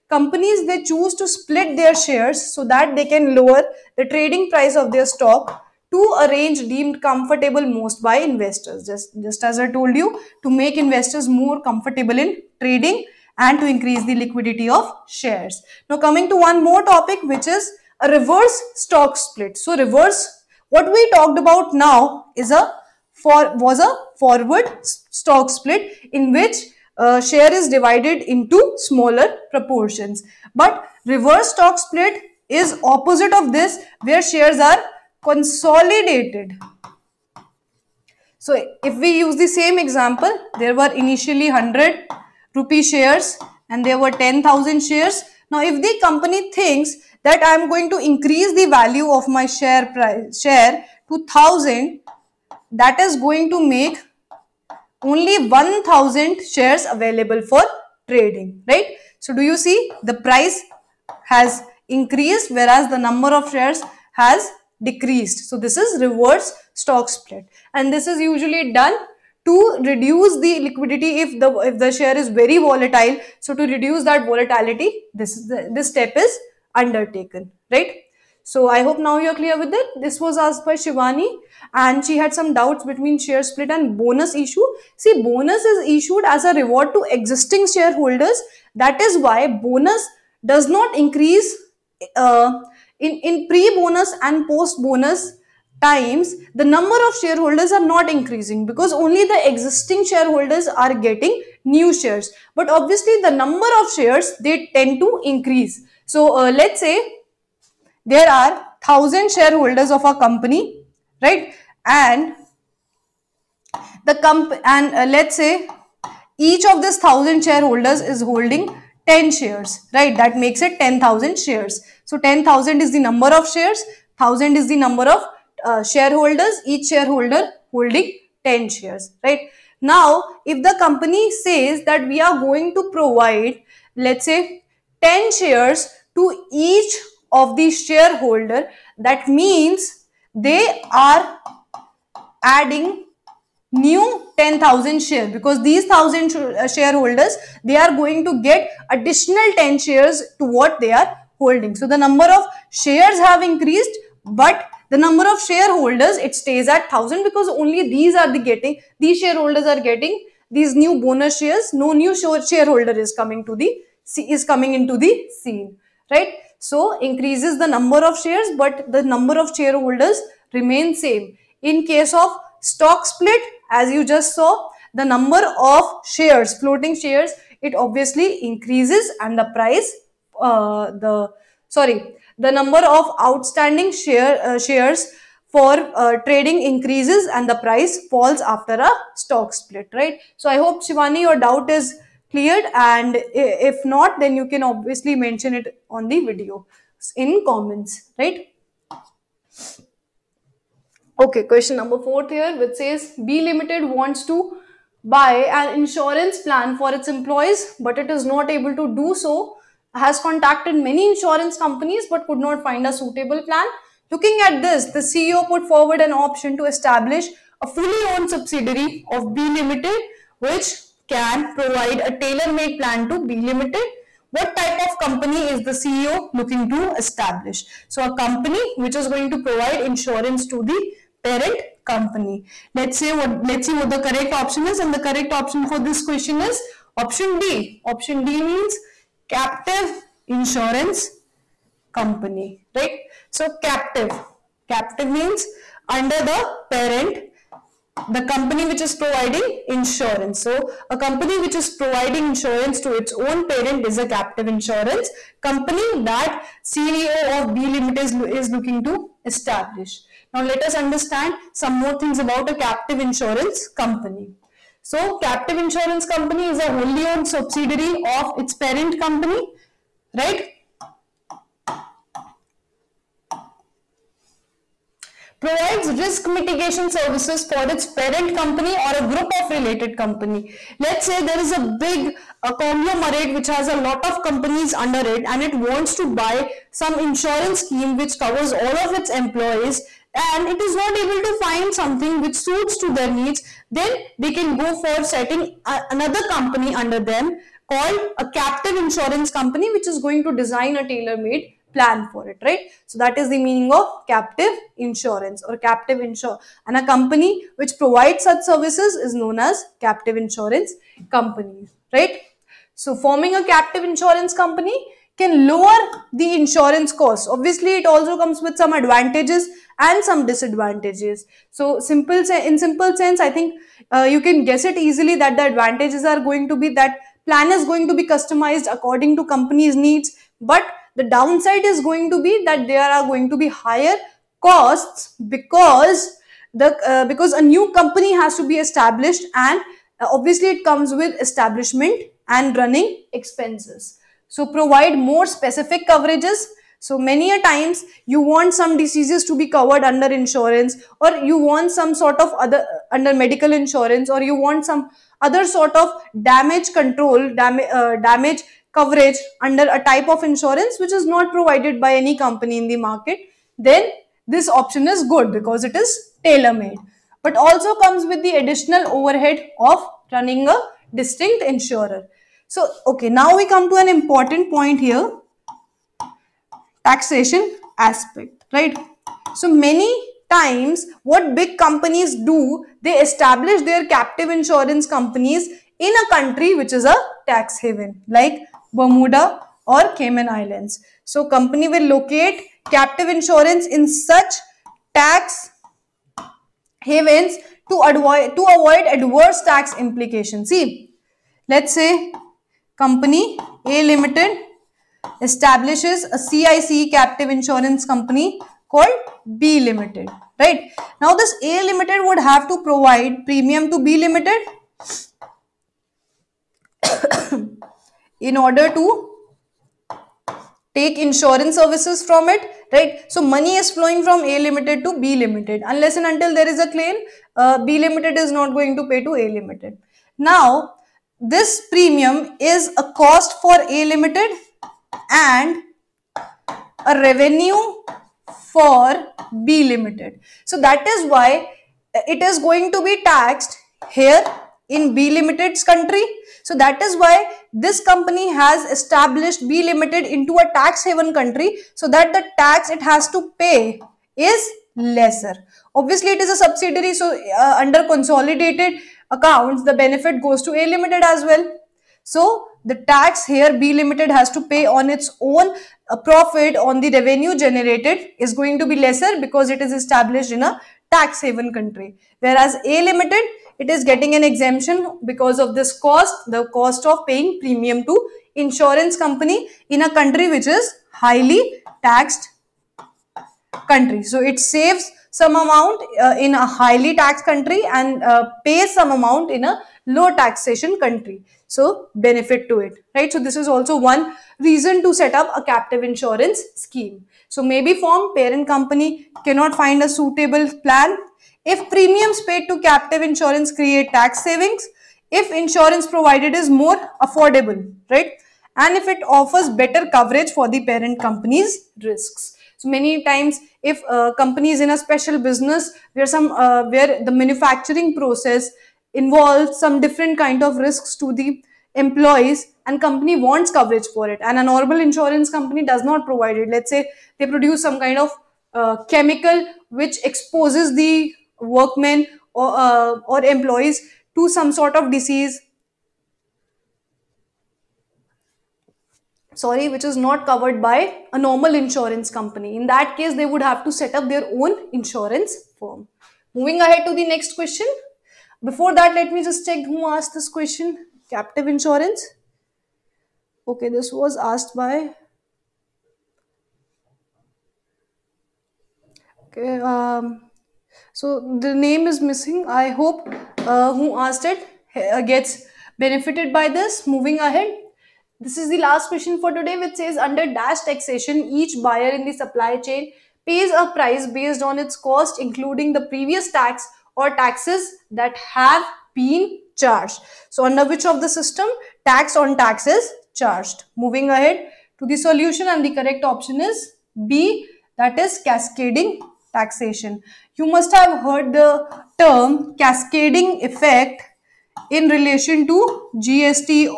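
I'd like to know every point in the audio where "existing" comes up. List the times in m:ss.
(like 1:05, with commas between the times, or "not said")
1:27, 1:39.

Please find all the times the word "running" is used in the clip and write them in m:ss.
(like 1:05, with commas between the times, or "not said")
5:42, 6:10.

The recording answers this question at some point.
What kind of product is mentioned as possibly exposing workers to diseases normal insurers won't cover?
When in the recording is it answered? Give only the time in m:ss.
8:48.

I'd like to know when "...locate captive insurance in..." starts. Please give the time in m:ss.
6:31.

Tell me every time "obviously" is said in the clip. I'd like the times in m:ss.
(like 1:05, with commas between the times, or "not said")
1:42, 2:57, 3:14, 5:17, 5:40, 7:35.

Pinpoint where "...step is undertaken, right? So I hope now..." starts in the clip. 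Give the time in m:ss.
1:15.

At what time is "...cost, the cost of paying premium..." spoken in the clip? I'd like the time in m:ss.
7:55.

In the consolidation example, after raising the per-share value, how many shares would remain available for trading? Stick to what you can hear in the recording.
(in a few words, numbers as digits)
1000.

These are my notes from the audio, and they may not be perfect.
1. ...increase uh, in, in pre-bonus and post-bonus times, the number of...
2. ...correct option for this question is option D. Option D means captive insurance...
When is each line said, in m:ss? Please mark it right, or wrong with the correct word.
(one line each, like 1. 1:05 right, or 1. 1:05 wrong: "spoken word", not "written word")
1. 1:30 right
2. 3:54 right.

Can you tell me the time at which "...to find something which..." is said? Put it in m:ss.
4:51.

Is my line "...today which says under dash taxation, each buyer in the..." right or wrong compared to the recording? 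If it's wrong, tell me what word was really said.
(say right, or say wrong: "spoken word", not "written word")
right.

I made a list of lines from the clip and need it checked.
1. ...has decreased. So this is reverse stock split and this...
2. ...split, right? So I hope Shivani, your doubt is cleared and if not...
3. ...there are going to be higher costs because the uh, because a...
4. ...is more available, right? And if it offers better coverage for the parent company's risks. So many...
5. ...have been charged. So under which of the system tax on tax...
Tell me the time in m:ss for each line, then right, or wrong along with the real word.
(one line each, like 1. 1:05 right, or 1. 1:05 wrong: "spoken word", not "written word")
1. 1:04 right
2. 3:09 right
3. 5:32 right
4. 8:26 wrong: "affordable", not "available"
5. 9:38 right.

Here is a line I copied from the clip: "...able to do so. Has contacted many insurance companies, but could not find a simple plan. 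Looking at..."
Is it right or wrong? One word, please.
wrong.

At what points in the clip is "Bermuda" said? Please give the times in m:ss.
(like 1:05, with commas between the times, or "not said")
6:28.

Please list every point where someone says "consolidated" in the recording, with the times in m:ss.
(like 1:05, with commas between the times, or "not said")
0:35, 7:37.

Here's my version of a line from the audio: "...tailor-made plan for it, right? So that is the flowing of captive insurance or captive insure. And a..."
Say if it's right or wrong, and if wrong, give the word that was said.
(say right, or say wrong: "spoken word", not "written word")
wrong: "meaning", not "flowing".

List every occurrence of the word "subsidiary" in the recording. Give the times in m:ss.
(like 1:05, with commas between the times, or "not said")
3:38, 4:27, 7:36.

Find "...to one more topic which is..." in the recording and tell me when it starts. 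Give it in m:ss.
0:16.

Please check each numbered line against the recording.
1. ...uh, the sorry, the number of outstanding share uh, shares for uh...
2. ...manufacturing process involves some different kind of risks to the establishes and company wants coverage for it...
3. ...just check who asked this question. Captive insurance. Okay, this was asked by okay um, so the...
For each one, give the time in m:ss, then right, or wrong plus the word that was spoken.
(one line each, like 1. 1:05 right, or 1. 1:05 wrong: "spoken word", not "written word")
1. 3:00 right
2. 8:37 wrong: "employees", not "establishes"
3. 9:09 right.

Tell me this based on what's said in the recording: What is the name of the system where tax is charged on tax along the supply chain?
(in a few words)
cascading taxation.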